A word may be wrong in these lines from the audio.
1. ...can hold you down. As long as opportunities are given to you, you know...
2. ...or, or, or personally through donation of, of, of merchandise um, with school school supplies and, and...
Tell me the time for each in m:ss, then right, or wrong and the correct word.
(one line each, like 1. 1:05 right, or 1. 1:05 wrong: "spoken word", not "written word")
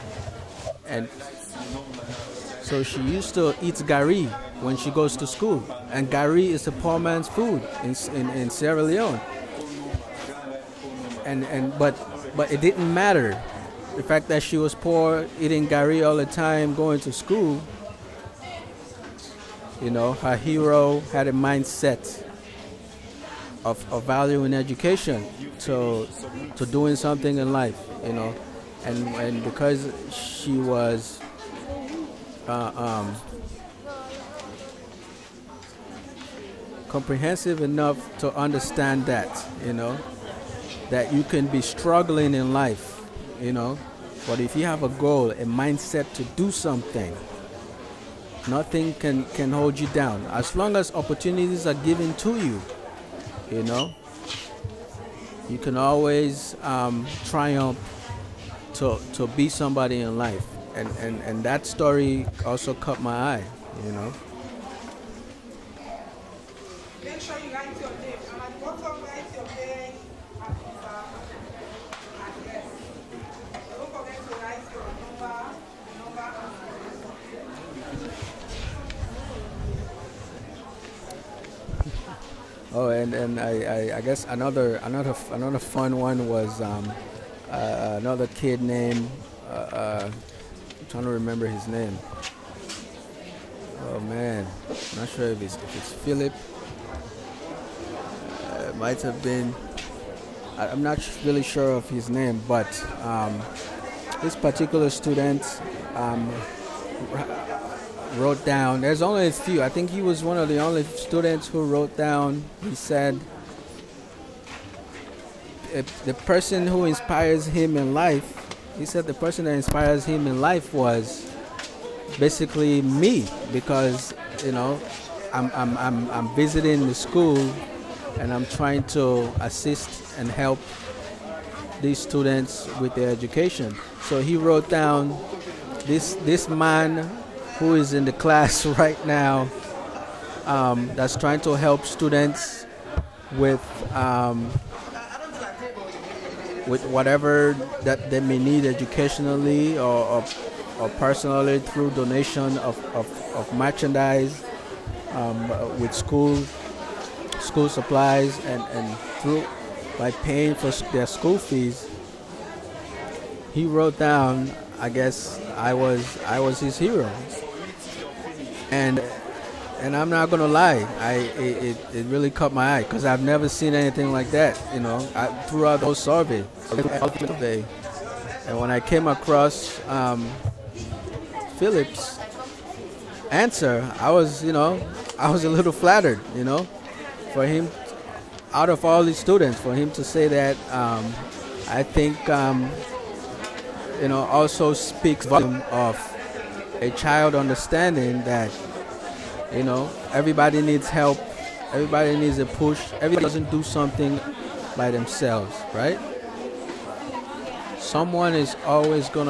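1. 0:49 right
2. 2:29 right.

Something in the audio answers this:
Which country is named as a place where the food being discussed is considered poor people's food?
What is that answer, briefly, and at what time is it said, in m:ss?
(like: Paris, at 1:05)
Sierra Leone, at 0:08.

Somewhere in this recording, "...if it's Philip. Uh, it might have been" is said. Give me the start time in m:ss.
1:35.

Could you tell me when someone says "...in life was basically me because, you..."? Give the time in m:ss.
2:00.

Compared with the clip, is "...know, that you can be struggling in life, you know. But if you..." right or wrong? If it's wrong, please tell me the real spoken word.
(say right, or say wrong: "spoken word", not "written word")
right.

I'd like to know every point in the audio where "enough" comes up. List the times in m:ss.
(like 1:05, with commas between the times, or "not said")
0:37.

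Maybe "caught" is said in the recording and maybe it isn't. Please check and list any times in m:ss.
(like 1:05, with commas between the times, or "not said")
1:02, 2:52.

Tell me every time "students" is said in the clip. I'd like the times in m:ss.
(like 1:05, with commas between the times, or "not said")
1:44, 1:50, 2:11, 2:21, 3:09.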